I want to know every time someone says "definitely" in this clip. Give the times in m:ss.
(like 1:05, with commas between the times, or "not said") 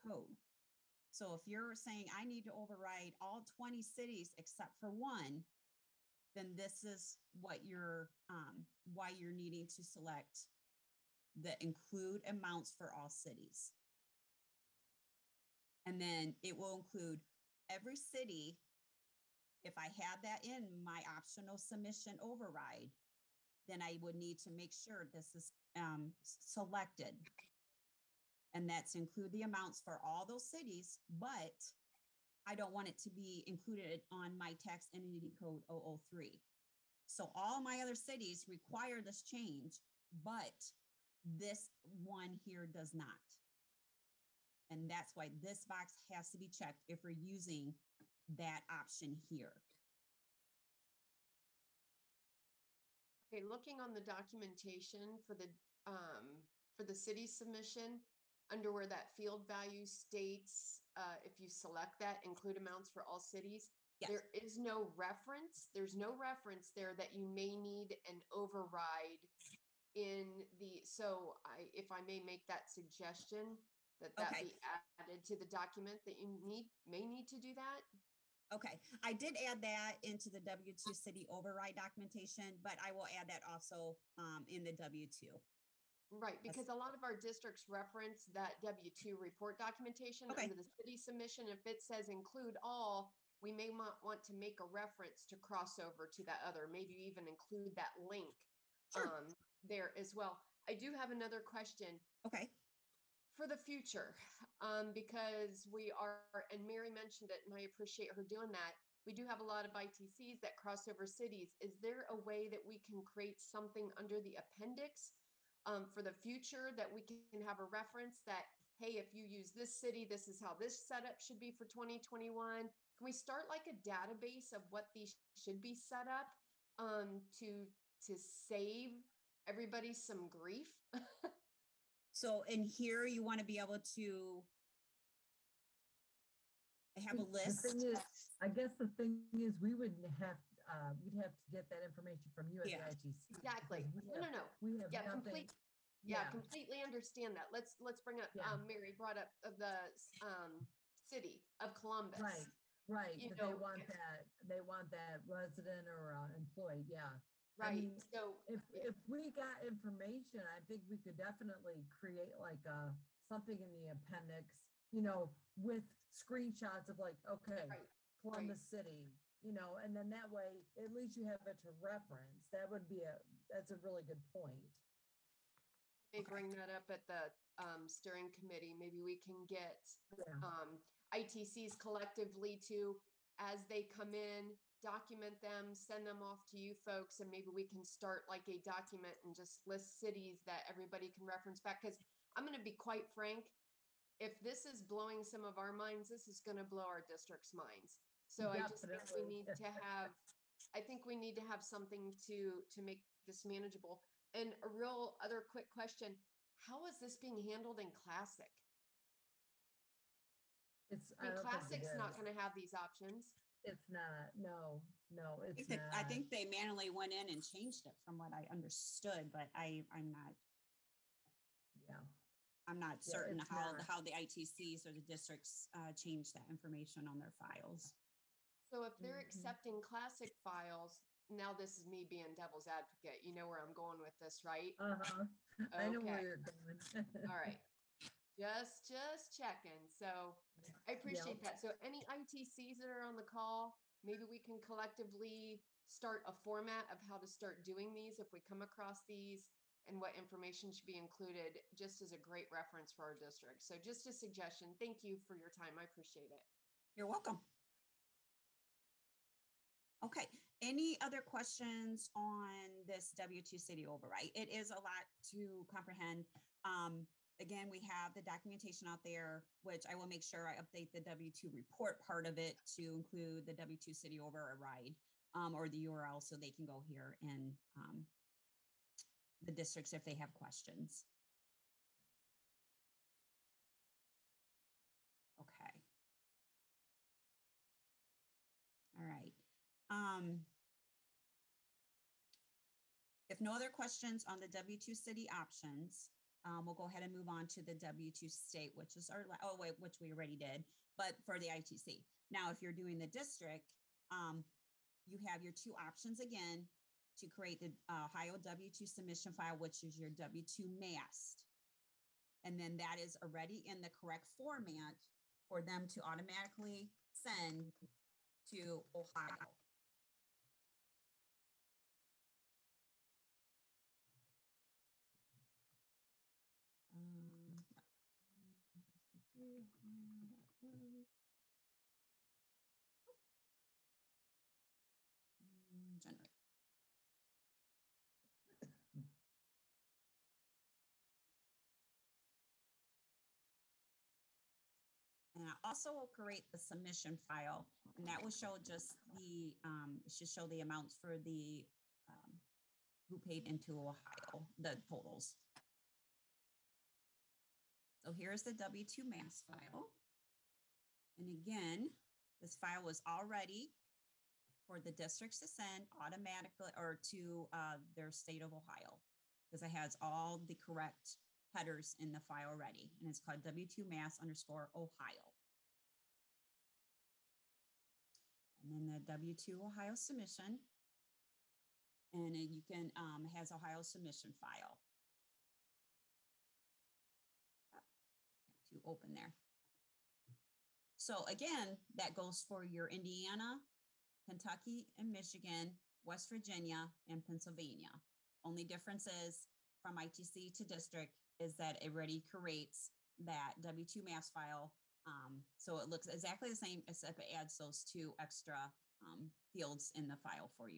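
2:41, 3:18.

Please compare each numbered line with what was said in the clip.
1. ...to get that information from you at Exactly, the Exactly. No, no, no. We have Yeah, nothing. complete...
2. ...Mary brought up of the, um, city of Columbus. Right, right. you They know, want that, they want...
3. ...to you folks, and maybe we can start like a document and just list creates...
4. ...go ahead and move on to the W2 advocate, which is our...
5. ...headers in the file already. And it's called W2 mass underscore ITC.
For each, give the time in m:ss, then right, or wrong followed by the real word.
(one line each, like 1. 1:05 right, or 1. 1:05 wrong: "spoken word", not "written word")
1. 2:21 wrong: "Yeah", not "Exactly"
2. 2:28 right
3. 3:06 wrong: "cities", not "creates"
4. 4:56 wrong: "state", not "advocate"
5. 6:11 wrong: "Ohio", not "ITC".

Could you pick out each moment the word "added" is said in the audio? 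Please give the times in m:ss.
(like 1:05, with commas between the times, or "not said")
1:14.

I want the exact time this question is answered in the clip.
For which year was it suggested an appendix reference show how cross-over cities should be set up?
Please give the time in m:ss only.
2:01.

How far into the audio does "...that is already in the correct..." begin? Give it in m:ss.
5:12.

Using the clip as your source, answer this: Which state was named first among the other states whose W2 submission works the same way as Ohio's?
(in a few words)
Indiana.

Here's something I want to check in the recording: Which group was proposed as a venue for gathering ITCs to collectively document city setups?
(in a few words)
steering committee.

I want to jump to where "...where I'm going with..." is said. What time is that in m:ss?
3:53.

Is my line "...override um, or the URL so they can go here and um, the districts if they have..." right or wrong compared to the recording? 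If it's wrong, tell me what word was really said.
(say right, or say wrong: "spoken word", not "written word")
right.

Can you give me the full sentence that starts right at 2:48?
City, you know, and then that way at least you have it to reference.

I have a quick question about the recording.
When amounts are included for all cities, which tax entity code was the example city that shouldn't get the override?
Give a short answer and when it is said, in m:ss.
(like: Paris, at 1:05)
003, at 0:35.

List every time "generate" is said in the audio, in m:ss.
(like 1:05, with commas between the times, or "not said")
5:35.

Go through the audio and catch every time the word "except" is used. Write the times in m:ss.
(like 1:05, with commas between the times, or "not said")
0:04, 6:46.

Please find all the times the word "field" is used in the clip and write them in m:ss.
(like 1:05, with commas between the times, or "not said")
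0:59, 6:49.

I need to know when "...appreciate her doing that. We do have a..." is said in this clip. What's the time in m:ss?
1:47.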